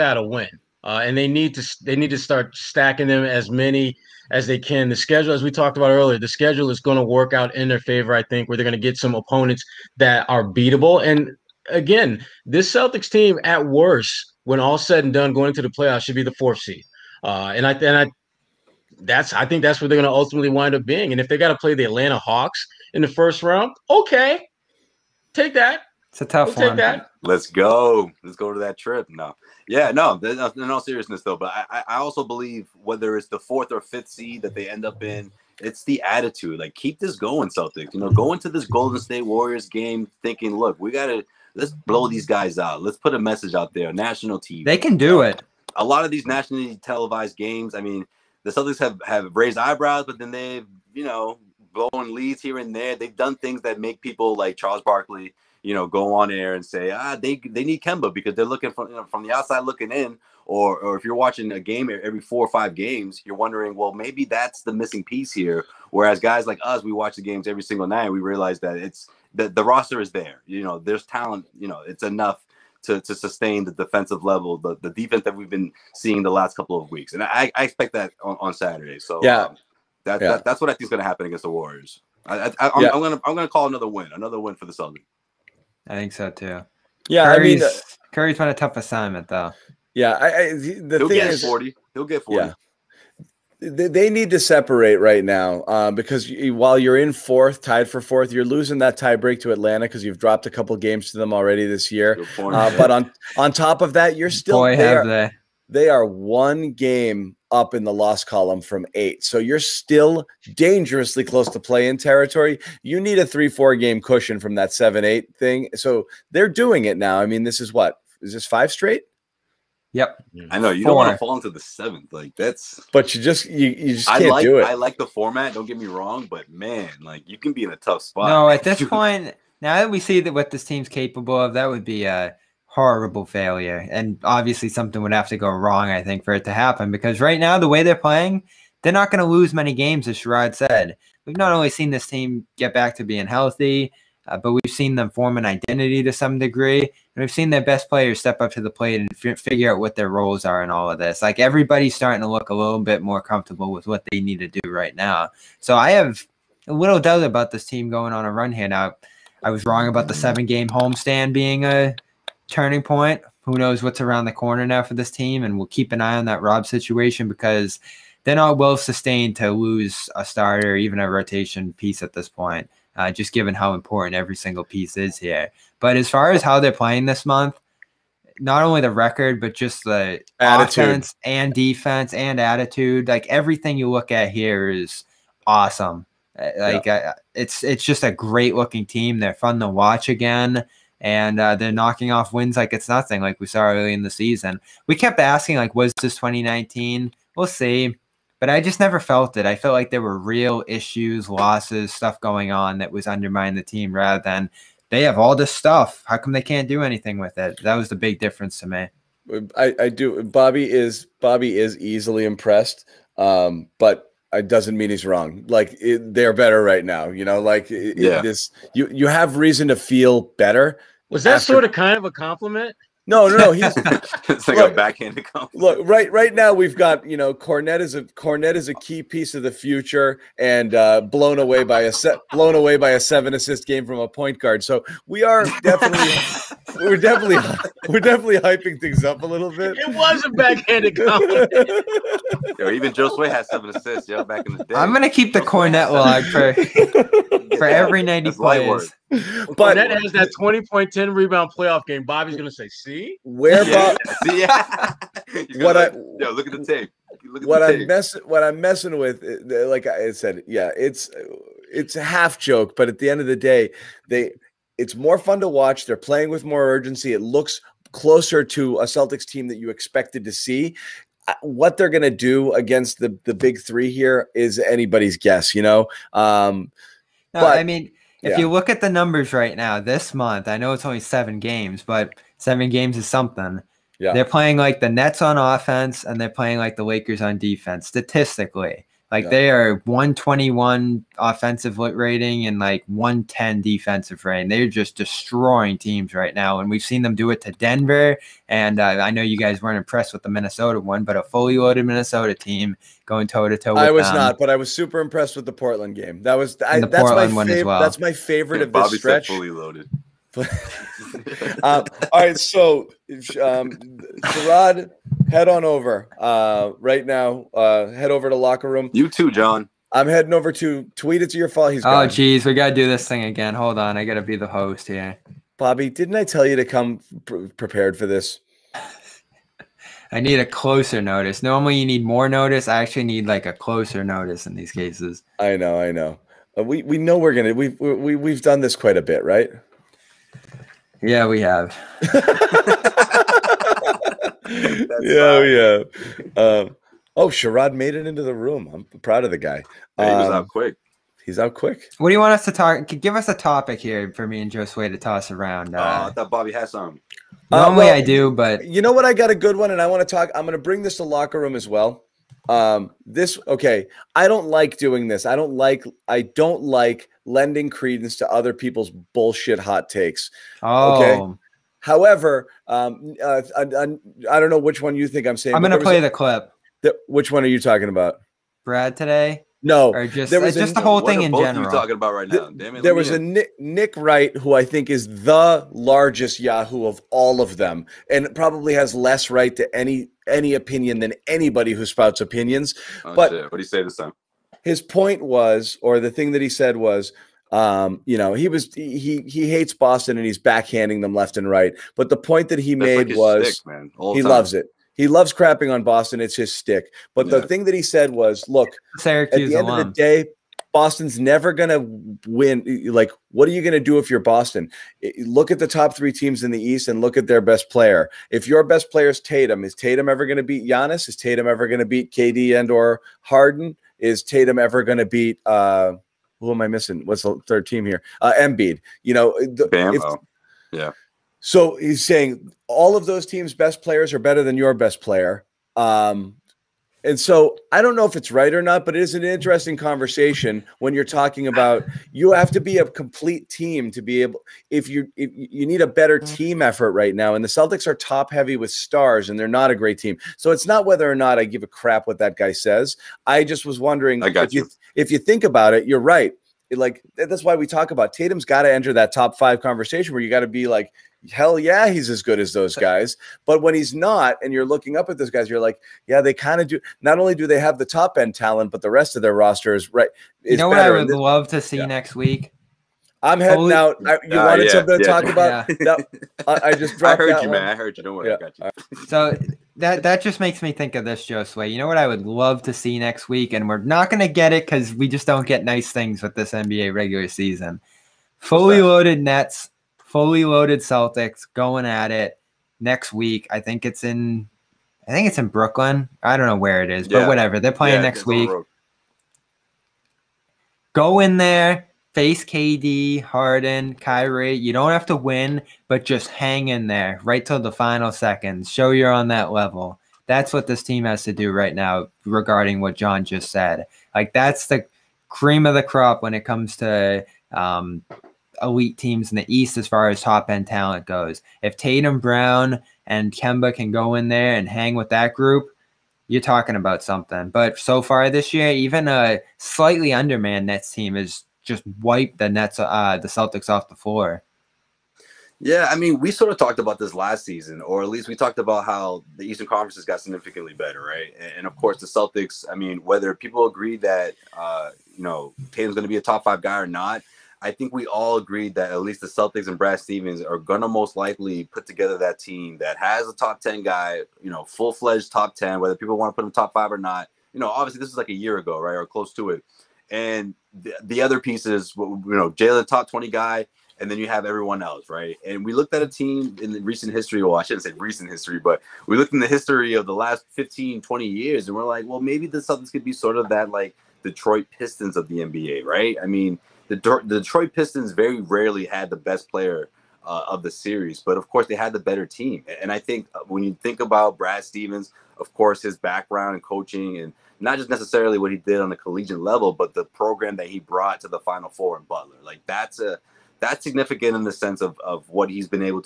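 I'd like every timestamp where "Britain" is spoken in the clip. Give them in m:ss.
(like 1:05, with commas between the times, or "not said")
not said.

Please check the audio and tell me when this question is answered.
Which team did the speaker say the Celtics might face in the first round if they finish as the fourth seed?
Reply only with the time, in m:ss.
0:21.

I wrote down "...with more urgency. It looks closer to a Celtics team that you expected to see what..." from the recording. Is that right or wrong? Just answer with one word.
right.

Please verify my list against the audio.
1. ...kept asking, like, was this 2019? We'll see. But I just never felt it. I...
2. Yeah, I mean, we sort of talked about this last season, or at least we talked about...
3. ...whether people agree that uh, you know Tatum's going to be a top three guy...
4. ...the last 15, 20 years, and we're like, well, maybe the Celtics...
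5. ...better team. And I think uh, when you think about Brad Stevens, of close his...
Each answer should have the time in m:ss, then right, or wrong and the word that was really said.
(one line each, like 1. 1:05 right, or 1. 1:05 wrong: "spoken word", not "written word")
1. 3:14 right
2. 8:55 right
3. 9:03 wrong: "five", not "three"
4. 9:30 right
5. 9:41 wrong: "course", not "close".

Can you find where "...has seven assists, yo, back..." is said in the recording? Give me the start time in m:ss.
4:03.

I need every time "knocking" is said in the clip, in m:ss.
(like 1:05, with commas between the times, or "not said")
3:11.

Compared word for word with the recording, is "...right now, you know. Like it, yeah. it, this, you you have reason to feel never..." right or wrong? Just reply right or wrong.
wrong.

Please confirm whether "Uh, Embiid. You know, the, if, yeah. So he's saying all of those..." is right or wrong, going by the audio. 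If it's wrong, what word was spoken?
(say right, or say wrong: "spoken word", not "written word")
right.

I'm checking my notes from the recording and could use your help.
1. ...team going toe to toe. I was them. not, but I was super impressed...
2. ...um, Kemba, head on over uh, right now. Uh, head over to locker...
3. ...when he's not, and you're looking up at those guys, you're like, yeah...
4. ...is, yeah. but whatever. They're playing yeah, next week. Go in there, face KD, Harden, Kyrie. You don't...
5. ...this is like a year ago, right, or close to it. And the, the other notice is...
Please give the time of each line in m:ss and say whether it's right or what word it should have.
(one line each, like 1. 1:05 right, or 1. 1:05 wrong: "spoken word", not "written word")
1. 5:02 right
2. 5:13 wrong: "Gerard", not "Kemba"
3. 7:43 right
4. 8:16 right
5. 9:18 wrong: "piece", not "notice".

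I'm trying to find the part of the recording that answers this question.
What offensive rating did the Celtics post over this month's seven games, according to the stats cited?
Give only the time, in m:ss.
4:49.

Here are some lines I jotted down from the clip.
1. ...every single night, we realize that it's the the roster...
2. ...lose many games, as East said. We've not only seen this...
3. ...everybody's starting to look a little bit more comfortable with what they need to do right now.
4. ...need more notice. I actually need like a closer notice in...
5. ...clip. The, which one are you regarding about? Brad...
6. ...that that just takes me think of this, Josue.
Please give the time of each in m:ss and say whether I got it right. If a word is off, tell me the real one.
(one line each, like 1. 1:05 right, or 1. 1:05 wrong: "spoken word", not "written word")
1. 1:07 right
2. 2:19 wrong: "Sherrod", not "East"
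3. 2:31 right
4. 5:31 right
5. 6:16 wrong: "talking", not "regarding"
6. 7:59 wrong: "makes", not "takes".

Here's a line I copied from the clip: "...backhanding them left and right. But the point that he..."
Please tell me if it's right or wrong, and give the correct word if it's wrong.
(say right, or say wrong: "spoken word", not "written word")
right.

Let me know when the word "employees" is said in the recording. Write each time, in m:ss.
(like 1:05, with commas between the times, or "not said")
not said.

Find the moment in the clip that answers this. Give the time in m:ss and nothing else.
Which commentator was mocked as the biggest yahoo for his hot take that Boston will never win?
6:23.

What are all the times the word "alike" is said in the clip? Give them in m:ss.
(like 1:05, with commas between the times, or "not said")
not said.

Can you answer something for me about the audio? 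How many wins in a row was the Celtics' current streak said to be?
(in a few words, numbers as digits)
5.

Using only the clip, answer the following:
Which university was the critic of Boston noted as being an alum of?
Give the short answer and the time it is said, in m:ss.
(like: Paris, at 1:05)
Syracuse, at 6:48.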